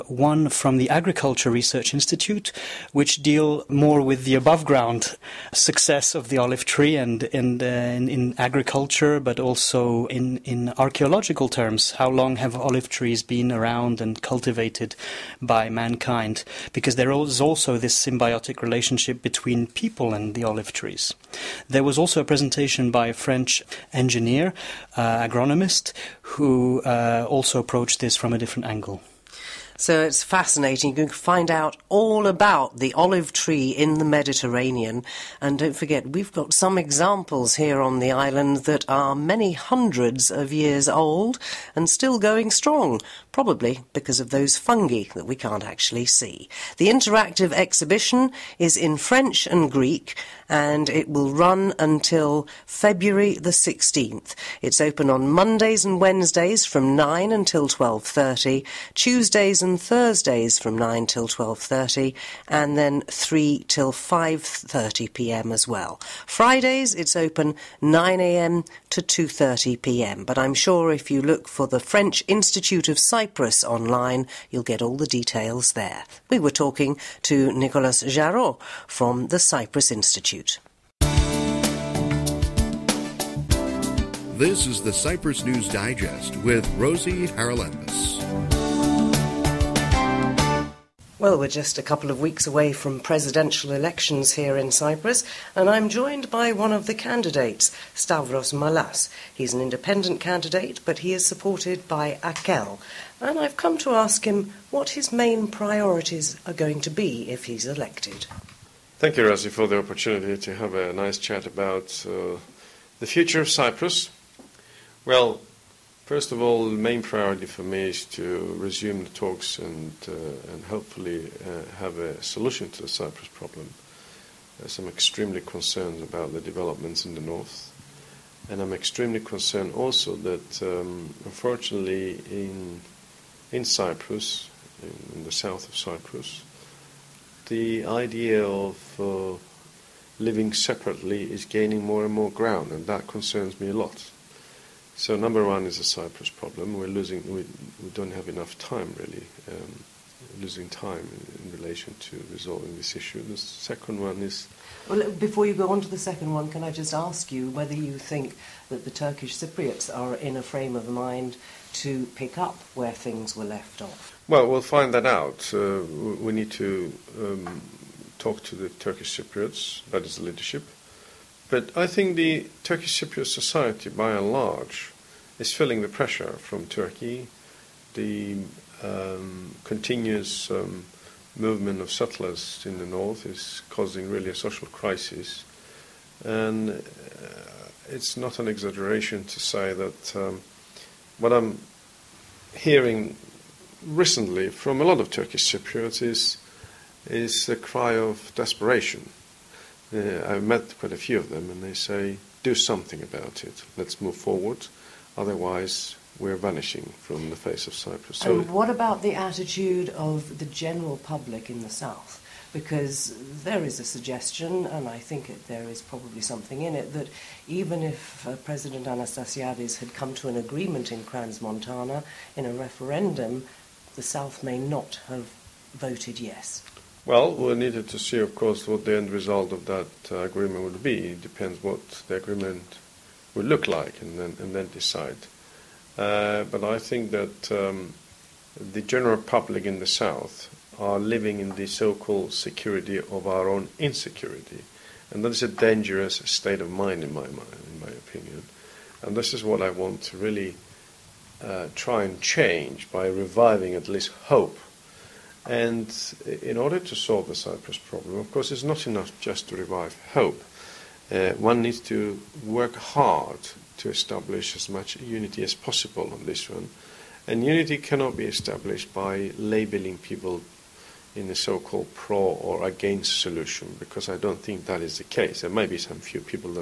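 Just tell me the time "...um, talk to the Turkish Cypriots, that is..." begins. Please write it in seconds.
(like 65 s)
167 s.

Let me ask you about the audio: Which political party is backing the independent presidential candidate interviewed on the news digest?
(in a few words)
Akel.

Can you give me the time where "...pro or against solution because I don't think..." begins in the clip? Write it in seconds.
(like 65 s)
271 s.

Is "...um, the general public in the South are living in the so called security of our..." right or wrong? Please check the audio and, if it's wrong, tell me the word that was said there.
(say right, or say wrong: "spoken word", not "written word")
right.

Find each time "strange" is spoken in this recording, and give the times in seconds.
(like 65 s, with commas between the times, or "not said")
not said.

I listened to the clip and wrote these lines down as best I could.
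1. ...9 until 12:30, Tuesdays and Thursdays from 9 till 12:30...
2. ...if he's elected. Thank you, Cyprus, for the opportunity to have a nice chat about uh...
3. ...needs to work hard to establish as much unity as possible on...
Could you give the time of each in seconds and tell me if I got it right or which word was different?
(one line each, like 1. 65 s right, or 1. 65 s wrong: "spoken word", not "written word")
1. 56 s right
2. 107 s wrong: "Rosie", not "Cyprus"
3. 261 s right.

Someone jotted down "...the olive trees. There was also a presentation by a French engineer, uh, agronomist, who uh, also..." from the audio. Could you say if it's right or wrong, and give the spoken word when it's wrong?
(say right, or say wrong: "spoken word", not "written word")
right.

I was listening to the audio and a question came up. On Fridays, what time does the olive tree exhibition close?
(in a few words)
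2:30 p.m.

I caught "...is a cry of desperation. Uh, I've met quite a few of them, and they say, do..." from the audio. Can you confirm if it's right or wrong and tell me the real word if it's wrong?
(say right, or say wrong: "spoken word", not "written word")
right.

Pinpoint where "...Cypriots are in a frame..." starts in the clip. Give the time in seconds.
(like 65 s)
159 s.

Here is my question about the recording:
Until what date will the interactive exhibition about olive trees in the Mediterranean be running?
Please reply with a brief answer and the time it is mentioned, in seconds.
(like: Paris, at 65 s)
February 16th, at 52 s.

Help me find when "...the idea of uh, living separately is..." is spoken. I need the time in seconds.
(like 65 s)
137 s.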